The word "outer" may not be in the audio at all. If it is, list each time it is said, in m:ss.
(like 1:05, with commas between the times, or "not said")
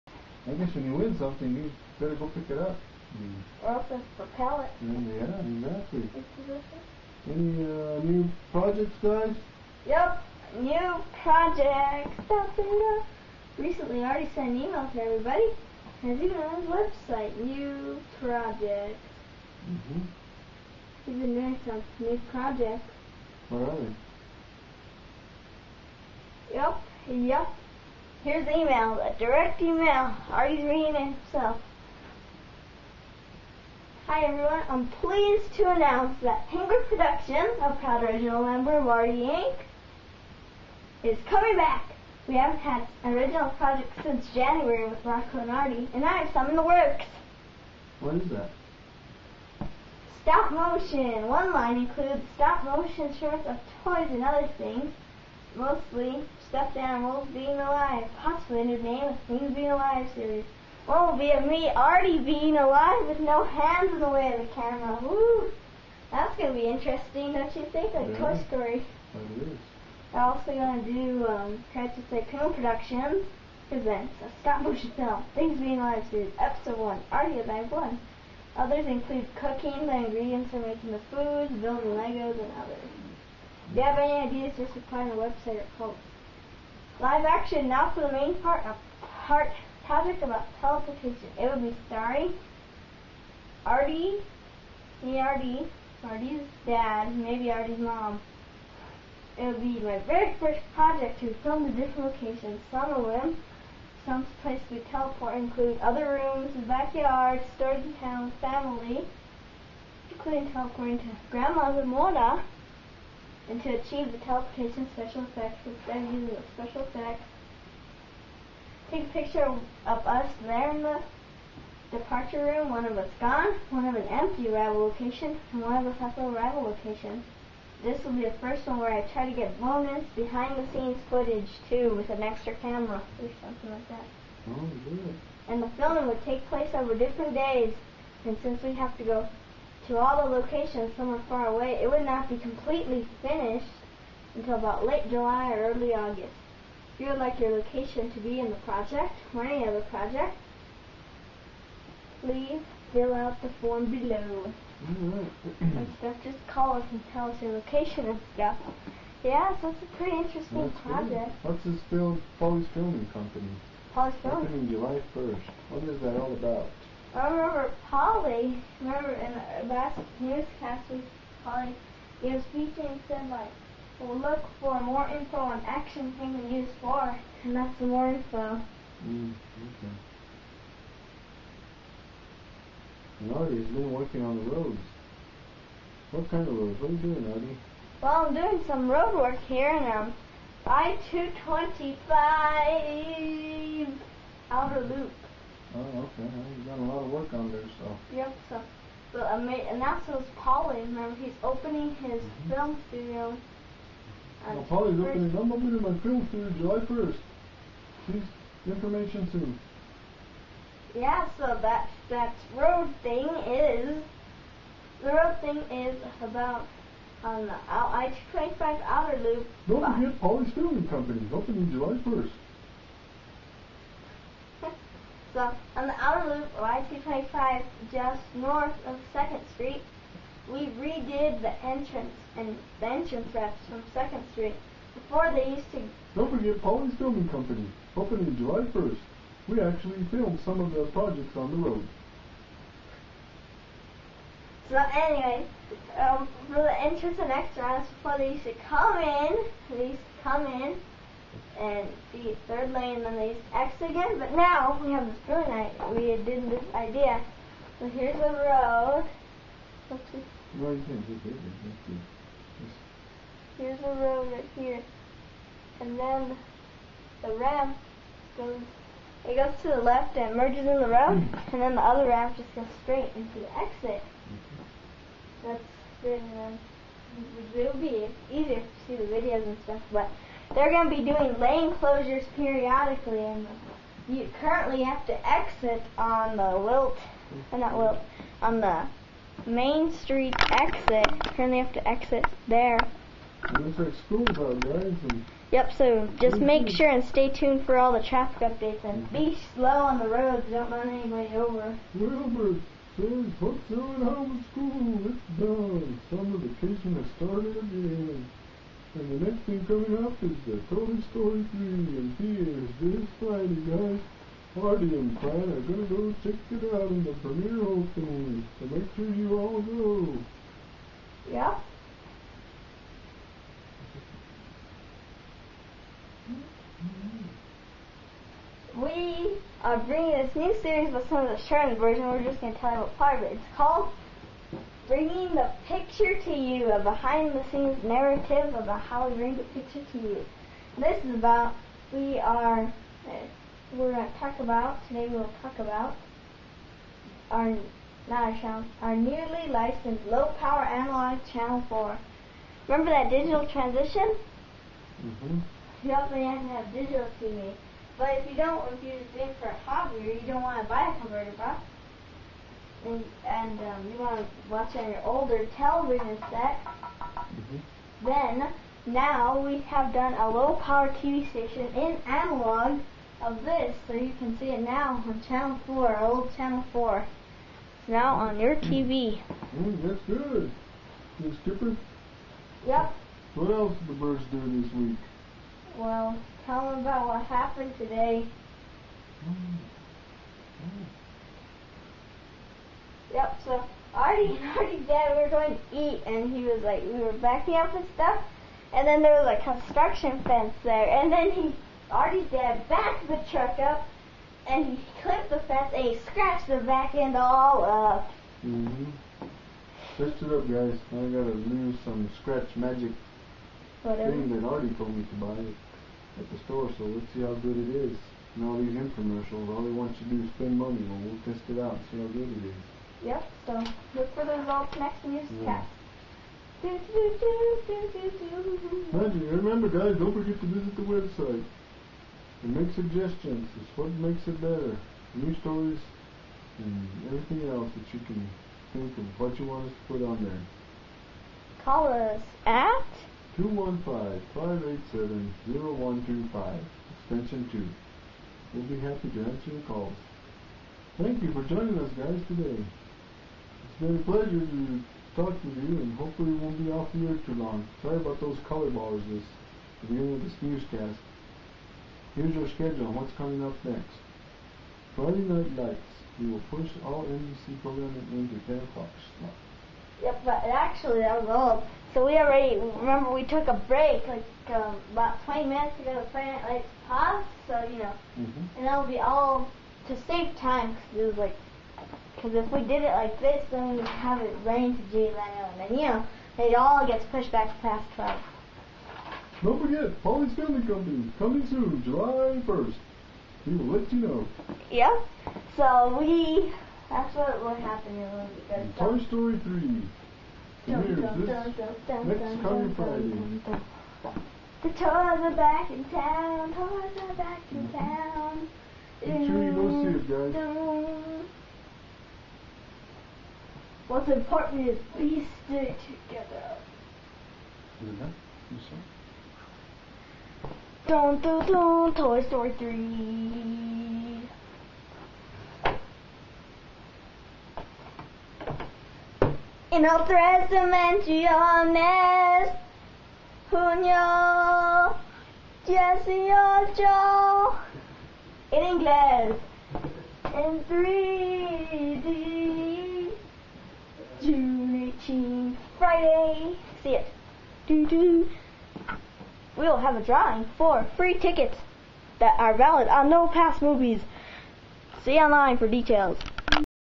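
3:14, 3:38, 3:45.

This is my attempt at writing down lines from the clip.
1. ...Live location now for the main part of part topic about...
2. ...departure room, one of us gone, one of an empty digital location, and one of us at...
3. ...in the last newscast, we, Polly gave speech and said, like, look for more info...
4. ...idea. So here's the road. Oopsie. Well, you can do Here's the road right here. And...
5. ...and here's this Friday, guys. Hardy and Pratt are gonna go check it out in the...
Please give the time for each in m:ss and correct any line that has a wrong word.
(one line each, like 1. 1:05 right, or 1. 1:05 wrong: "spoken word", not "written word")
1. 1:26 wrong: "action", not "location"
2. 2:01 wrong: "arrival", not "digital"
3. 2:49 right
4. 4:16 right
5. 5:11 right.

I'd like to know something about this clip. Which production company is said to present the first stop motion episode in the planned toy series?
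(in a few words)
Crisis Tycoon Productions.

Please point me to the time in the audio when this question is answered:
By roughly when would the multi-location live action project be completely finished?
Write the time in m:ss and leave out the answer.
2:24.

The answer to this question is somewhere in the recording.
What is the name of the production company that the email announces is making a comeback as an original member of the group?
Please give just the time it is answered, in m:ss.
0:36.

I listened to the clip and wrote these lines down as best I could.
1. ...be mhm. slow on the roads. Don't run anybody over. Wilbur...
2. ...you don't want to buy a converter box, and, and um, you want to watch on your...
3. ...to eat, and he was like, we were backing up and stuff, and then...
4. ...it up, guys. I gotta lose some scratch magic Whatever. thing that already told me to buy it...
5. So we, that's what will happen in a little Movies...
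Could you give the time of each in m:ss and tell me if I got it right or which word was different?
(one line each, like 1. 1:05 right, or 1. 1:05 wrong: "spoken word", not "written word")
1. 4:59 right
2. 6:00 right
3. 6:35 right
4. 6:50 right
5. 8:15 wrong: "Toy", not "Movies".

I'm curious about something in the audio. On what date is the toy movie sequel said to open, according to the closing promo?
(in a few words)
June 18th.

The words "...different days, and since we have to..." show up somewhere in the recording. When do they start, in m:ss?
2:16.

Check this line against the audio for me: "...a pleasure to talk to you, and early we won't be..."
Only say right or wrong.
wrong.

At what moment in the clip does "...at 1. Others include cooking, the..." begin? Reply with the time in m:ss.
1:17.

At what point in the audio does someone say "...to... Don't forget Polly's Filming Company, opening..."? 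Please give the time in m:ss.
3:55.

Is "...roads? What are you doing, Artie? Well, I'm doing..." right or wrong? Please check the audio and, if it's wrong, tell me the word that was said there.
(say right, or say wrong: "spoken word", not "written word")
right.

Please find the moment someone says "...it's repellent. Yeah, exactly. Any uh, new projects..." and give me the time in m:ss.
0:03.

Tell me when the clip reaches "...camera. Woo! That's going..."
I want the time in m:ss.
1:04.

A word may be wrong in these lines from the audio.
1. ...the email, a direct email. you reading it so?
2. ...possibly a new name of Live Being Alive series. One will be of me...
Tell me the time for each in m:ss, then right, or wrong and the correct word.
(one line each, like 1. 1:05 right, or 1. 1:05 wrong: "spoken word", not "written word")
1. 0:28 right
2. 0:58 wrong: "Things", not "Live".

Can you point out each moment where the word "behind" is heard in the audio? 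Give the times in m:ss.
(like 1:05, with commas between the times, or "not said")
2:10, 5:36.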